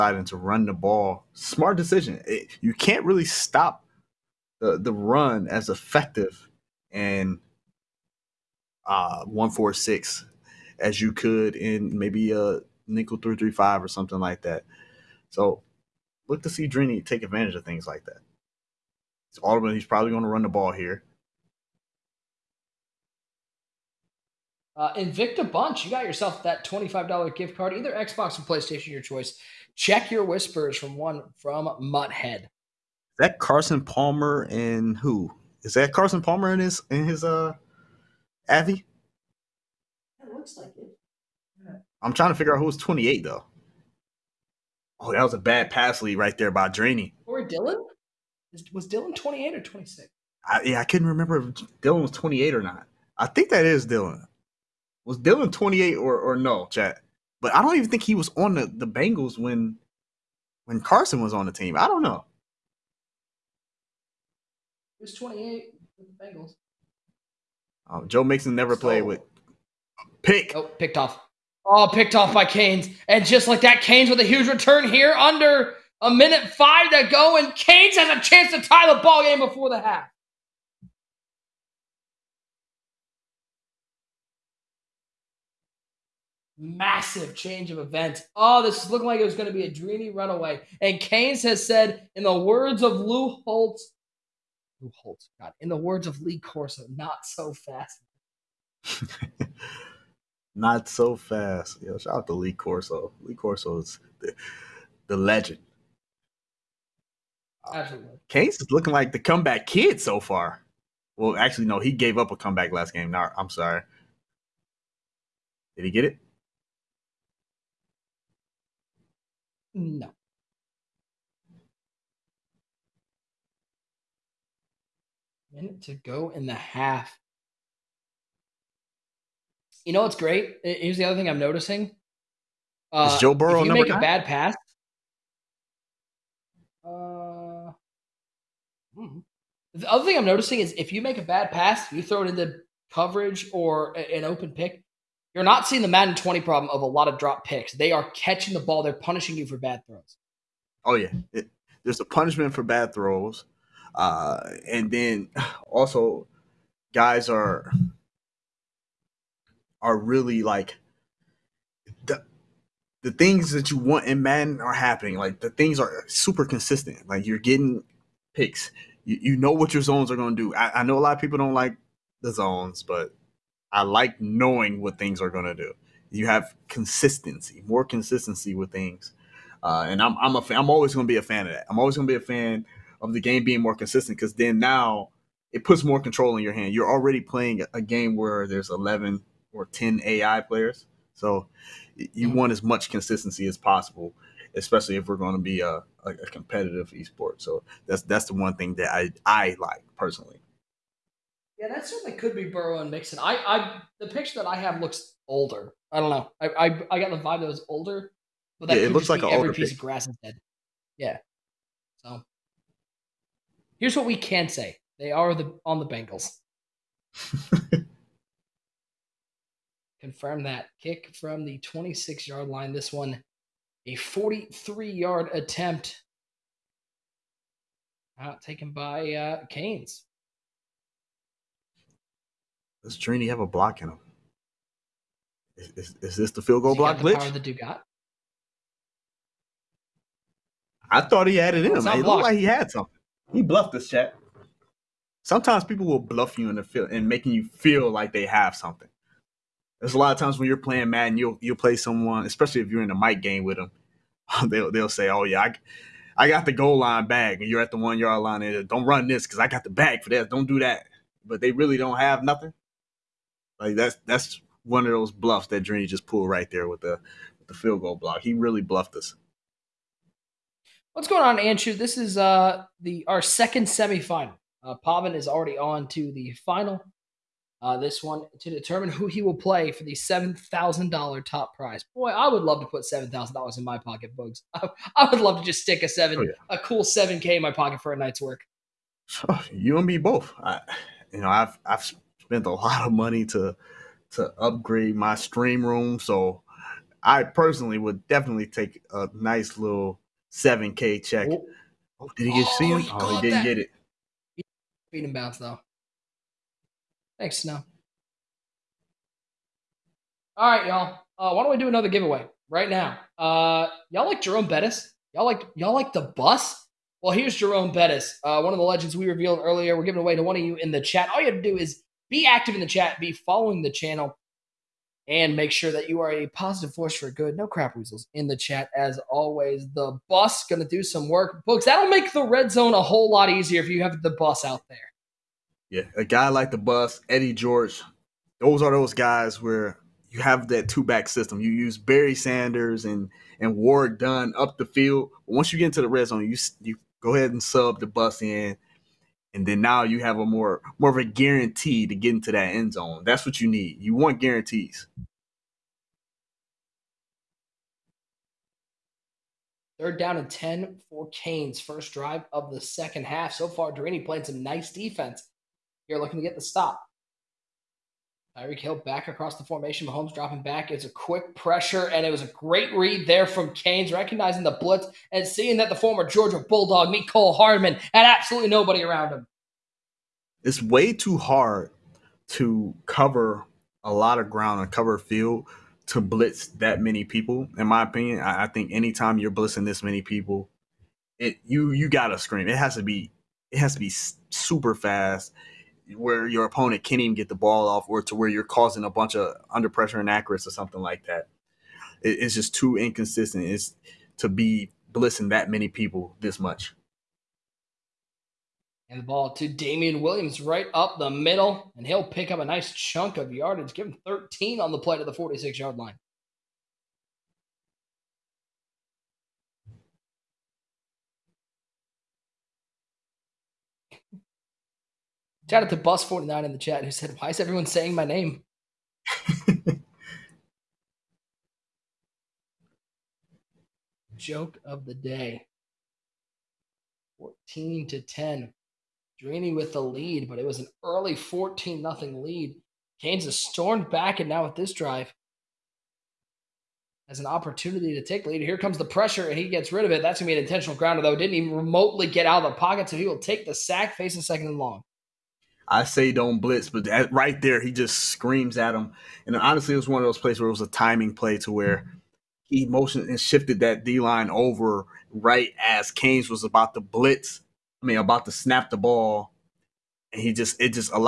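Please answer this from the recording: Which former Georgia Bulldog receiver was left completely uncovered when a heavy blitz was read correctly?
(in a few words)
Mecole Hardman.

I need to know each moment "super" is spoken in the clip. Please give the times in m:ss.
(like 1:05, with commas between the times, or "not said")
2:46, 6:33.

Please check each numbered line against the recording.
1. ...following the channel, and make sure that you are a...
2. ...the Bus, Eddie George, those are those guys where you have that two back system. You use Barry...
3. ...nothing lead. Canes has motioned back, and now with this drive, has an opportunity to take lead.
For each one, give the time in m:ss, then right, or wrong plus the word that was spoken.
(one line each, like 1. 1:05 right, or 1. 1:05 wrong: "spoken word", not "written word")
1. 5:23 right
2. 5:36 right
3. 7:21 wrong: "stormed", not "motioned".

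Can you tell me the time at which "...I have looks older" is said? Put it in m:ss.
3:24.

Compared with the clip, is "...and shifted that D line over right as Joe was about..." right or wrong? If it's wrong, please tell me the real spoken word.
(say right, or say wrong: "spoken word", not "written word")
wrong: "Canes", not "Joe".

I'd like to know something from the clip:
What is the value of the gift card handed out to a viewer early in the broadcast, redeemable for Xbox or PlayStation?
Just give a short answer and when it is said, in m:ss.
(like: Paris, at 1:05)
$25, at 0:26.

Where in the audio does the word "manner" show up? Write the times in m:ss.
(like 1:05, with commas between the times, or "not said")
not said.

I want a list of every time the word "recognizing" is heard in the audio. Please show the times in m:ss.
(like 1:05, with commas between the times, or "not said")
6:13.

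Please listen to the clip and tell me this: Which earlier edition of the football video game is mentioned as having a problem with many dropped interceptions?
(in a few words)
Madden 20.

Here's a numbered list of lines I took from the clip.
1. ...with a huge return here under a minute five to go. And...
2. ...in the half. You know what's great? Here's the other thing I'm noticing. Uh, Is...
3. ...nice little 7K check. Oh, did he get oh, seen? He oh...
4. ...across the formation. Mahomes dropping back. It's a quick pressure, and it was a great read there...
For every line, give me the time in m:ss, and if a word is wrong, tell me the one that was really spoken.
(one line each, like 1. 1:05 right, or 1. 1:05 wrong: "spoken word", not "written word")
1. 1:14 right
2. 2:06 right
3. 4:59 right
4. 6:09 right.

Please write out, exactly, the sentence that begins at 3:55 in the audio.
Is, is, is this the field goal block glitch?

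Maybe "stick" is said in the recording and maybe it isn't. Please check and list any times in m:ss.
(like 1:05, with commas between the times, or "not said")
4:45.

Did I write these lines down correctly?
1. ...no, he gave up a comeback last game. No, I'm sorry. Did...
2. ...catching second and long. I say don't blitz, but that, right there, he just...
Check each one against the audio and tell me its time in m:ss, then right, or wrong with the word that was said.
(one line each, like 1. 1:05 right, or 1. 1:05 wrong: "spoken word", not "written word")
1. 1:51 right
2. 7:33 wrong: "facing", not "catching".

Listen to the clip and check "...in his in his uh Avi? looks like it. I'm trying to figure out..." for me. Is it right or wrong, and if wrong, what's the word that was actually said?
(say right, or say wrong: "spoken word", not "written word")
right.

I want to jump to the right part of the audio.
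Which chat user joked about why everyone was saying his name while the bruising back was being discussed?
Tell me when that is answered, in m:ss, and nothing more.
7:05.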